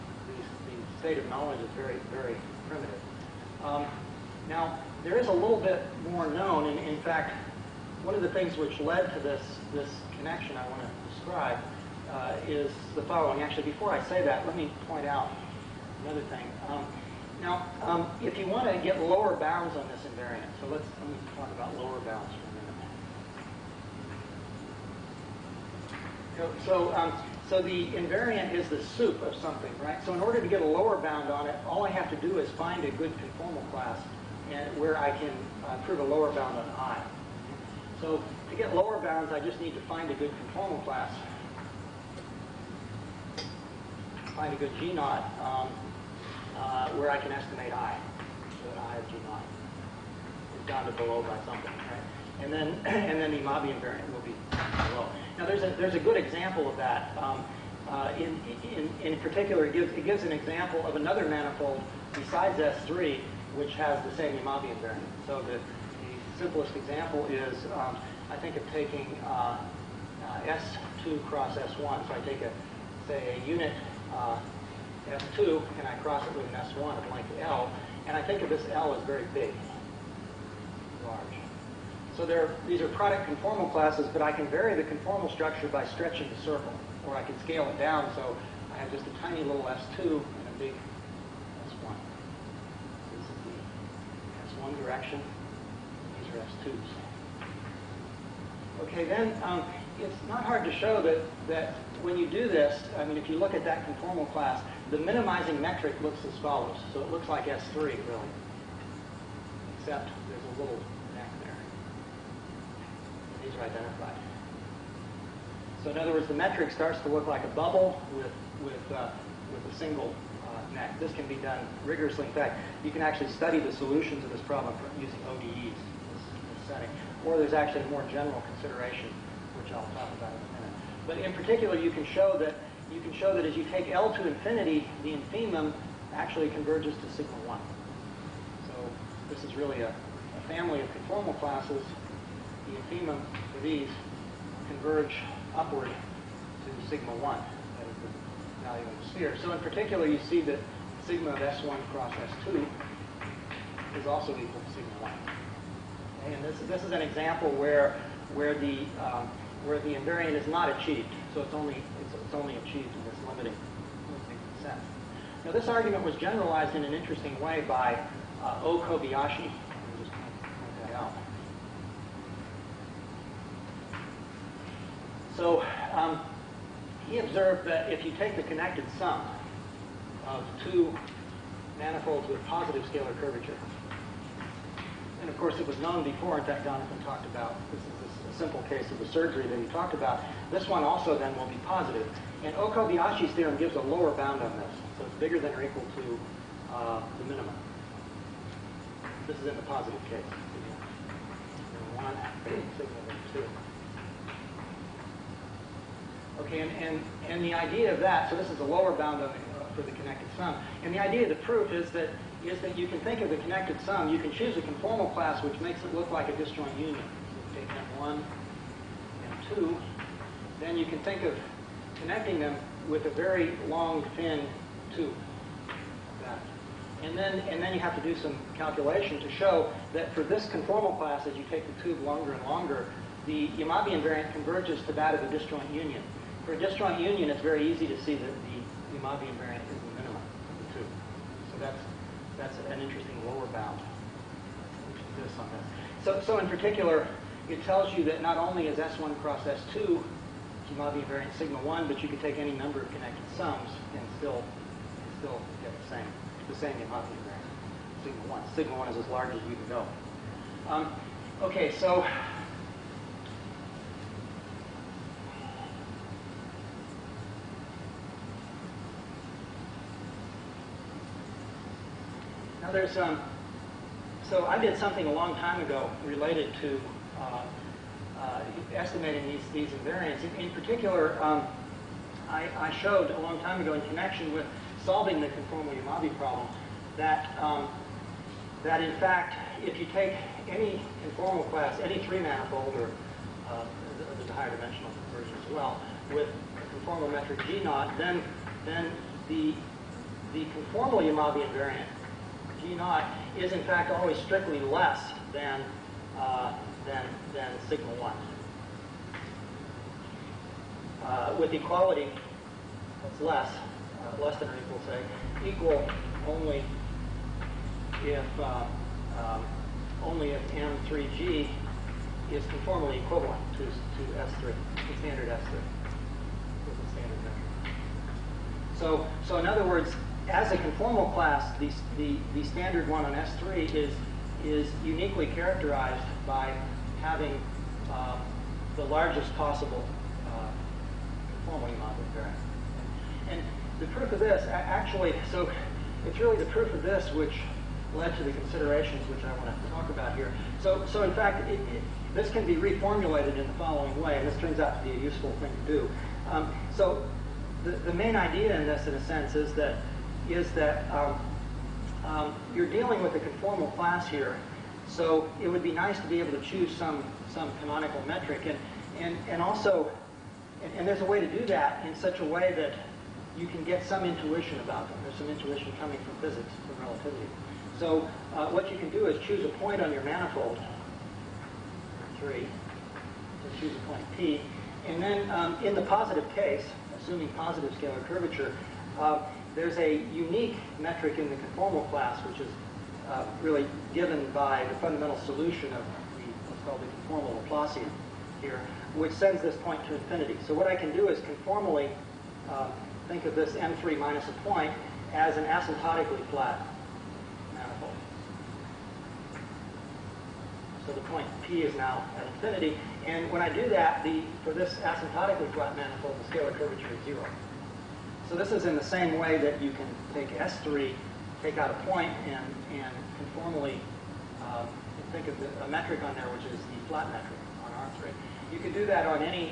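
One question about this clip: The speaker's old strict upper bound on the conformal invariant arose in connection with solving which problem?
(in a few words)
the conformal Yamabe problem.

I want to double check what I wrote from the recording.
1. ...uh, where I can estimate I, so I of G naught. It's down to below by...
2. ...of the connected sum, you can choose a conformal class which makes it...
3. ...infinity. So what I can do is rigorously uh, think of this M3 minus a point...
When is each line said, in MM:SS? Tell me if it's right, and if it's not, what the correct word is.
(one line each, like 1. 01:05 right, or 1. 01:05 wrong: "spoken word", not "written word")
1. 00:46 right
2. 03:33 right
3. 06:39 wrong: "conformally", not "rigorously".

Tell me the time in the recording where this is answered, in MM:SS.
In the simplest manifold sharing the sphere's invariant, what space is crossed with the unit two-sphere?
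01:10.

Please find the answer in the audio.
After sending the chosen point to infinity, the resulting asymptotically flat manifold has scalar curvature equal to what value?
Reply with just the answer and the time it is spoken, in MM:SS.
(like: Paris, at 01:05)
0, at 06:57.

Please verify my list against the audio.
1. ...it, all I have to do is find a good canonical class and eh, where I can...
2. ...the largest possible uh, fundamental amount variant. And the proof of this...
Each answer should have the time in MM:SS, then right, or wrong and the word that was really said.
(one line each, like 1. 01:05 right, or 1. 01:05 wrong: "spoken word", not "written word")
1. 00:31 wrong: "conformal", not "canonical"
2. 05:38 wrong: "conformal", not "fundamental".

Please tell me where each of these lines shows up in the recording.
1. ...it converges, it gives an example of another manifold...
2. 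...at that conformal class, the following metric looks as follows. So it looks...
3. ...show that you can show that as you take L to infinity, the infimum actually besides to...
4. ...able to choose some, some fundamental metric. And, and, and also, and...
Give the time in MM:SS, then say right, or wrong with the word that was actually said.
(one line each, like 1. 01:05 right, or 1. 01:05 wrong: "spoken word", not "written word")
1. 00:59 wrong: "gives", not "converges"
2. 01:43 wrong: "minimizing", not "following"
3. 02:12 wrong: "converges", not "besides"
4. 06:06 wrong: "canonical", not "fundamental".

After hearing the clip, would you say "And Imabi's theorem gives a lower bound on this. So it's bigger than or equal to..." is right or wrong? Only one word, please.
wrong.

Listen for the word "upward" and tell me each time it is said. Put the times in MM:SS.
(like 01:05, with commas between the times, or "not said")
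02:25.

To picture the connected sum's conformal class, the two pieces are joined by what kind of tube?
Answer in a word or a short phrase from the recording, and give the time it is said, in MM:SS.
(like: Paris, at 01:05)
a very long, thin tube, at 03:43.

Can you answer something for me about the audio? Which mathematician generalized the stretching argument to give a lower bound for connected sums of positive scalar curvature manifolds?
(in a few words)
O. Kobayashi.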